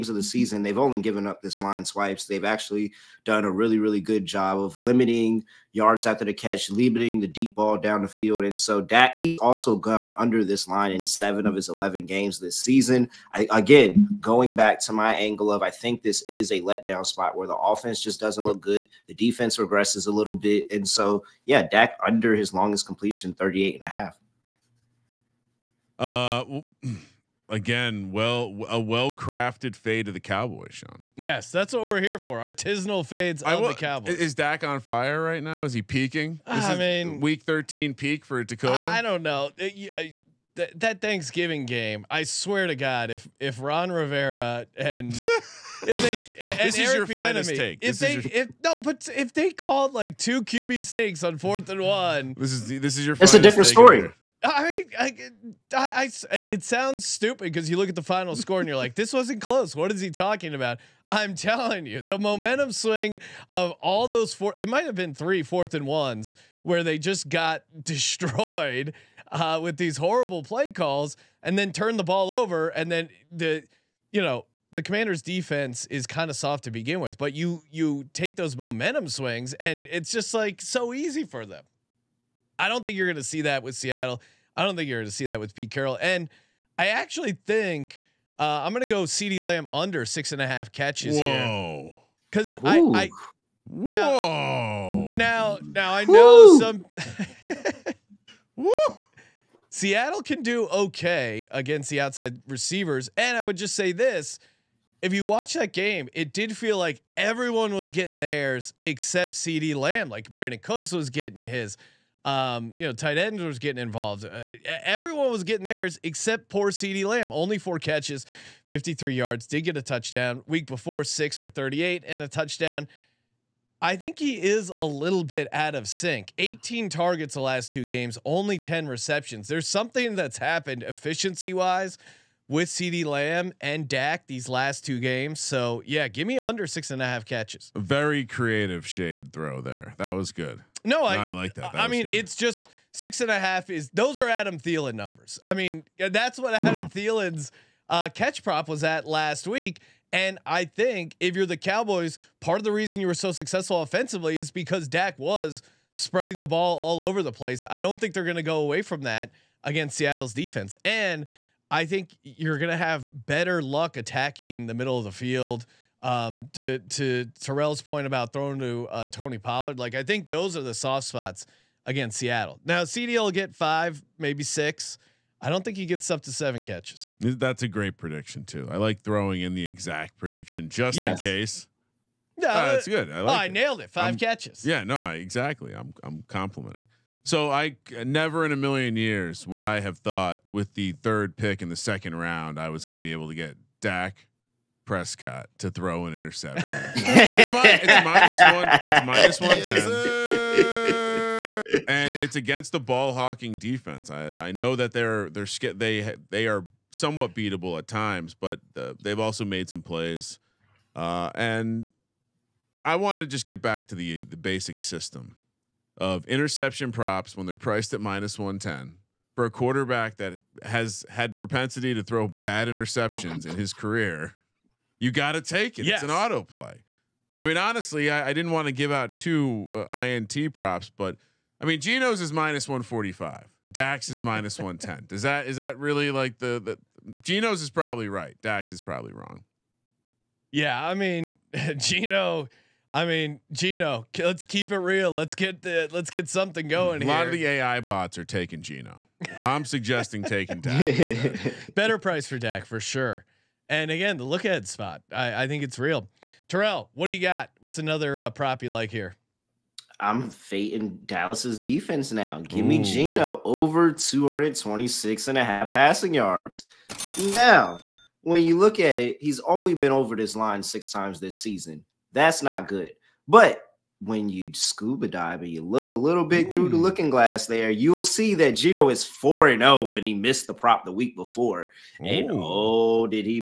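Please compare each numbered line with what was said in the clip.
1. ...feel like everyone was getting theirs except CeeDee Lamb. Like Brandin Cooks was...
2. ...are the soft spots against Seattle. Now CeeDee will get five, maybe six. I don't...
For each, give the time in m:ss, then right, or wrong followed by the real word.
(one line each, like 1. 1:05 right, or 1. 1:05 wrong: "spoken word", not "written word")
1. 1:46 right
2. 2:50 right.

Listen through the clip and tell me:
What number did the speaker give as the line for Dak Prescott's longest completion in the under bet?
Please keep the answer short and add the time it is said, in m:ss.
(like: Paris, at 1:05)
38.5, at 0:23.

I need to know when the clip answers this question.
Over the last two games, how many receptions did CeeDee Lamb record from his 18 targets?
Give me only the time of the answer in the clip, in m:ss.
2:08.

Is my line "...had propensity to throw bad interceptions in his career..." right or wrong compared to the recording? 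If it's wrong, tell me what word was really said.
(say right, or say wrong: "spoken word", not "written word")
right.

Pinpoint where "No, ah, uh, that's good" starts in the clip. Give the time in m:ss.
3:02.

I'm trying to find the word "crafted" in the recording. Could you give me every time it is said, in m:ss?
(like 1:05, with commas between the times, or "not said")
0:29.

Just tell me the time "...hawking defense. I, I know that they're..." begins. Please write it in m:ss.
3:23.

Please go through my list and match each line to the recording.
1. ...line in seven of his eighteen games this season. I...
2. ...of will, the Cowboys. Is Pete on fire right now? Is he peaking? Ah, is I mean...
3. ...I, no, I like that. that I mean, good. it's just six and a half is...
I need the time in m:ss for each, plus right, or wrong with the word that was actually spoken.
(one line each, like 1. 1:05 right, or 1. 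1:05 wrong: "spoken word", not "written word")
1. 0:10 wrong: "eleven", not "eighteen"
2. 0:33 wrong: "Dak", not "Pete"
3. 2:21 right.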